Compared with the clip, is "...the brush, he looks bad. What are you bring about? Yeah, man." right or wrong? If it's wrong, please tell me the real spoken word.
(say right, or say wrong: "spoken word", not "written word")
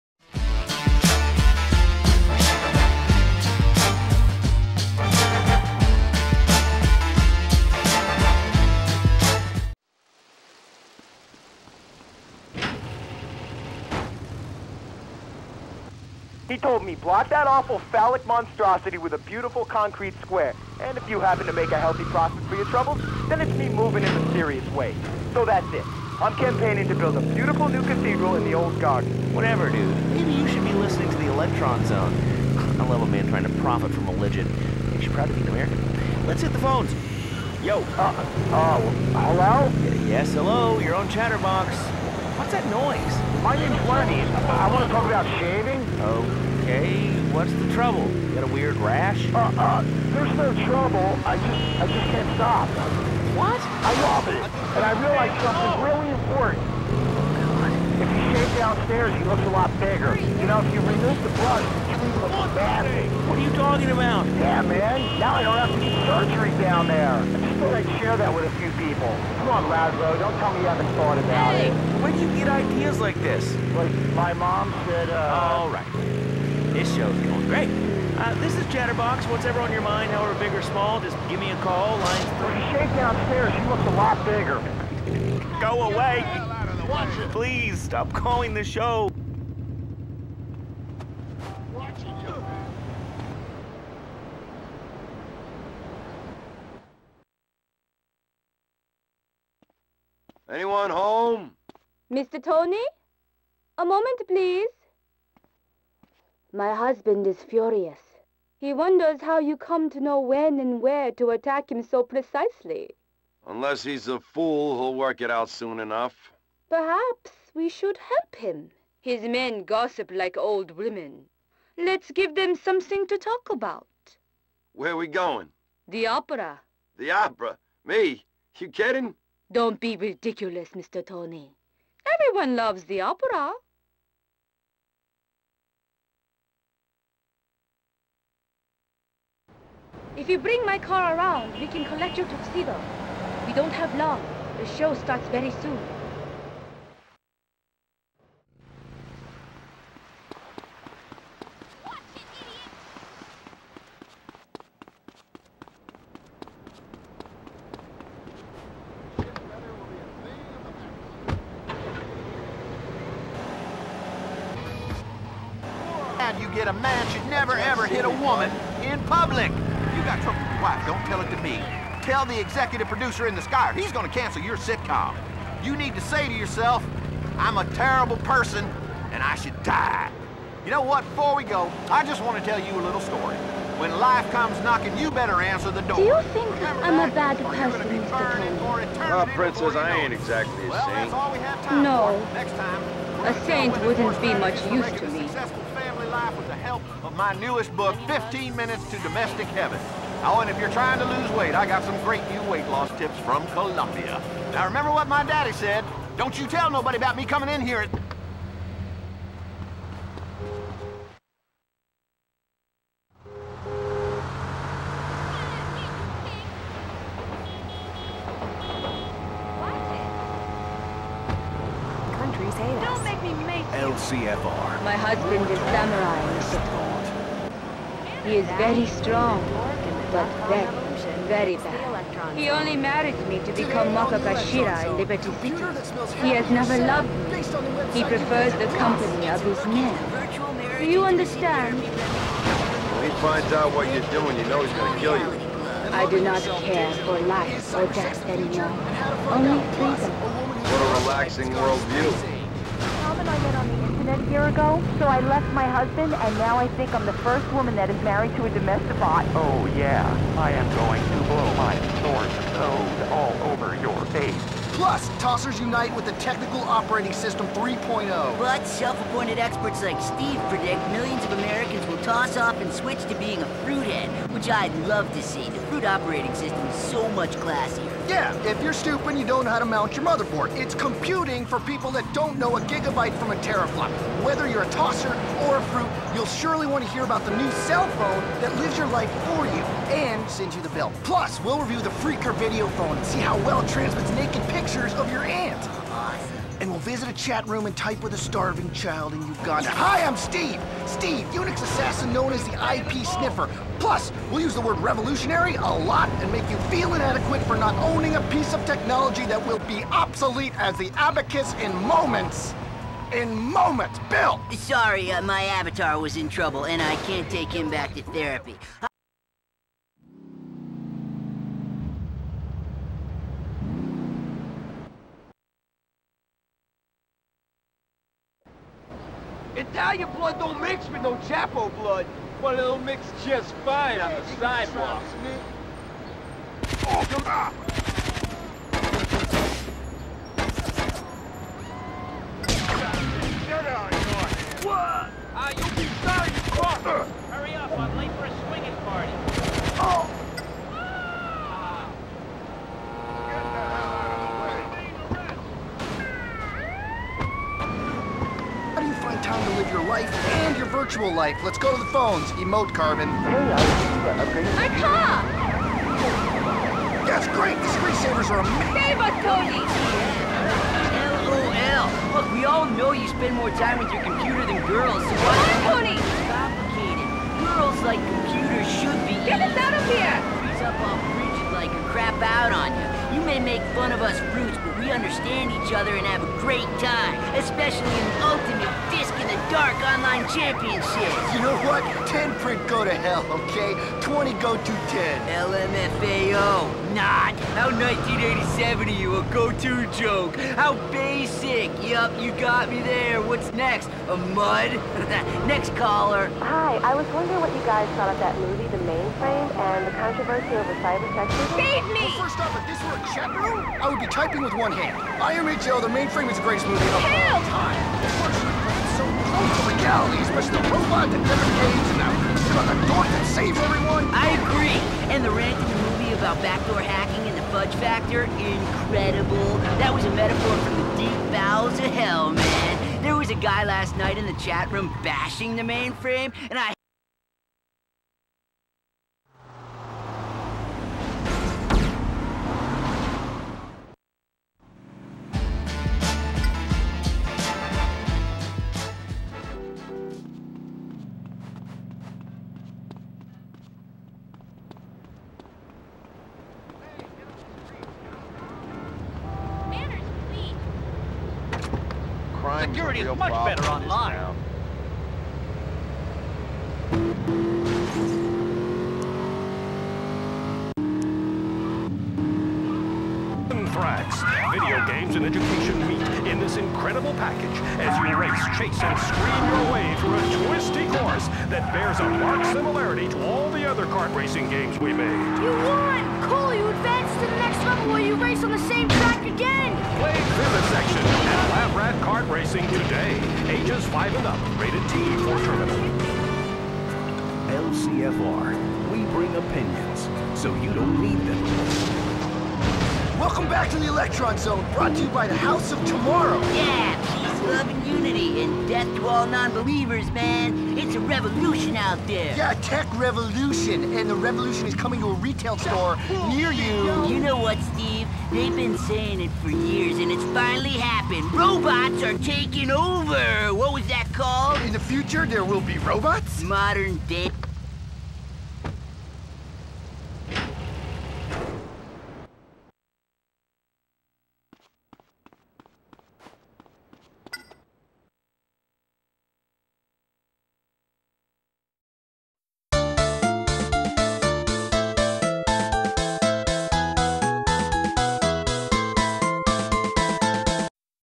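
wrong: "talking", not "bring".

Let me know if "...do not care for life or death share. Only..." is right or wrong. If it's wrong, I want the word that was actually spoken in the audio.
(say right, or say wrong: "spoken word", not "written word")
wrong: "anymore", not "share".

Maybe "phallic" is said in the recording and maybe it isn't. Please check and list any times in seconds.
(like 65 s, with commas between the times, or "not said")
17 s.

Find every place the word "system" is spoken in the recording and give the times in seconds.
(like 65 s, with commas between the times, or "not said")
267 s, 276 s.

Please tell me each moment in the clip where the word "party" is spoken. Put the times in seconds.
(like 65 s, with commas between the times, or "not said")
348 s.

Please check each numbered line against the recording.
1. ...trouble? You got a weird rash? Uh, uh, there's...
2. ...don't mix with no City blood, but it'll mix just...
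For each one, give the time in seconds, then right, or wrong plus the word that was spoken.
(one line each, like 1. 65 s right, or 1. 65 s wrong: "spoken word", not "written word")
1. 47 s right
2. 330 s wrong: "Chapo", not "City".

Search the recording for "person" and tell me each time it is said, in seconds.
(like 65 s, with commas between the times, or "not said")
178 s, 187 s.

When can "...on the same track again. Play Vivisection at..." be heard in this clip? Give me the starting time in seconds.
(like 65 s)
488 s.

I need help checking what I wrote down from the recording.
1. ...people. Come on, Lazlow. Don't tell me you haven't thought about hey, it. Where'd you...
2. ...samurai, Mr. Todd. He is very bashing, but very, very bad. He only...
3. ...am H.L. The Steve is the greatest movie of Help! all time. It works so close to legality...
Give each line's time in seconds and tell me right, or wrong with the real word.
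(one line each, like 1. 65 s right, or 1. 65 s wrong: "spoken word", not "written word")
1. 68 s right
2. 225 s wrong: "strong", not "bashing"
3. 415 s wrong: "Mainframe", not "Steve".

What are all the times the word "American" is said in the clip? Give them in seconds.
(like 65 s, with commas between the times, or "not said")
35 s, 271 s.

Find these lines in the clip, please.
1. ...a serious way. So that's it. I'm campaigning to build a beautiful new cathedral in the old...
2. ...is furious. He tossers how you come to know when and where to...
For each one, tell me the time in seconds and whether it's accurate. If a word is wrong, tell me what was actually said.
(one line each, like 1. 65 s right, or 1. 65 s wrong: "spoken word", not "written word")
1. 24 s right
2. 107 s wrong: "wonders", not "tossers".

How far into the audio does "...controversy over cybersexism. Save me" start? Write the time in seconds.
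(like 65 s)
409 s.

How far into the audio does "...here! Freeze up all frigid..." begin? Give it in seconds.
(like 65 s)
379 s.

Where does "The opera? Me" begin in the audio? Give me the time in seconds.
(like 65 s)
126 s.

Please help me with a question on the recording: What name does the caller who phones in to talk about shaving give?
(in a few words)
Lenny.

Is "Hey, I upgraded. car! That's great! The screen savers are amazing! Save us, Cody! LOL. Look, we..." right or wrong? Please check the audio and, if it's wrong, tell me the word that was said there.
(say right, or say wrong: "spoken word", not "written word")
right.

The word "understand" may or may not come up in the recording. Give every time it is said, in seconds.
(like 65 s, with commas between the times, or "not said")
241 s, 384 s.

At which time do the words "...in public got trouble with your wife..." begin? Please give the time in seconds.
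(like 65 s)
168 s.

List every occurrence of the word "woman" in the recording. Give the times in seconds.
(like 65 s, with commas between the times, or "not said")
168 s, 257 s.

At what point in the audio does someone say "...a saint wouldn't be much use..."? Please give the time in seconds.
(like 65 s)
193 s.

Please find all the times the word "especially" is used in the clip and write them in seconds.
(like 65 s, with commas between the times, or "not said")
387 s, 420 s.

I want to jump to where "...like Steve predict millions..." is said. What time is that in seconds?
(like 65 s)
269 s.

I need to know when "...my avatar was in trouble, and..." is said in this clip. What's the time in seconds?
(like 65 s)
315 s.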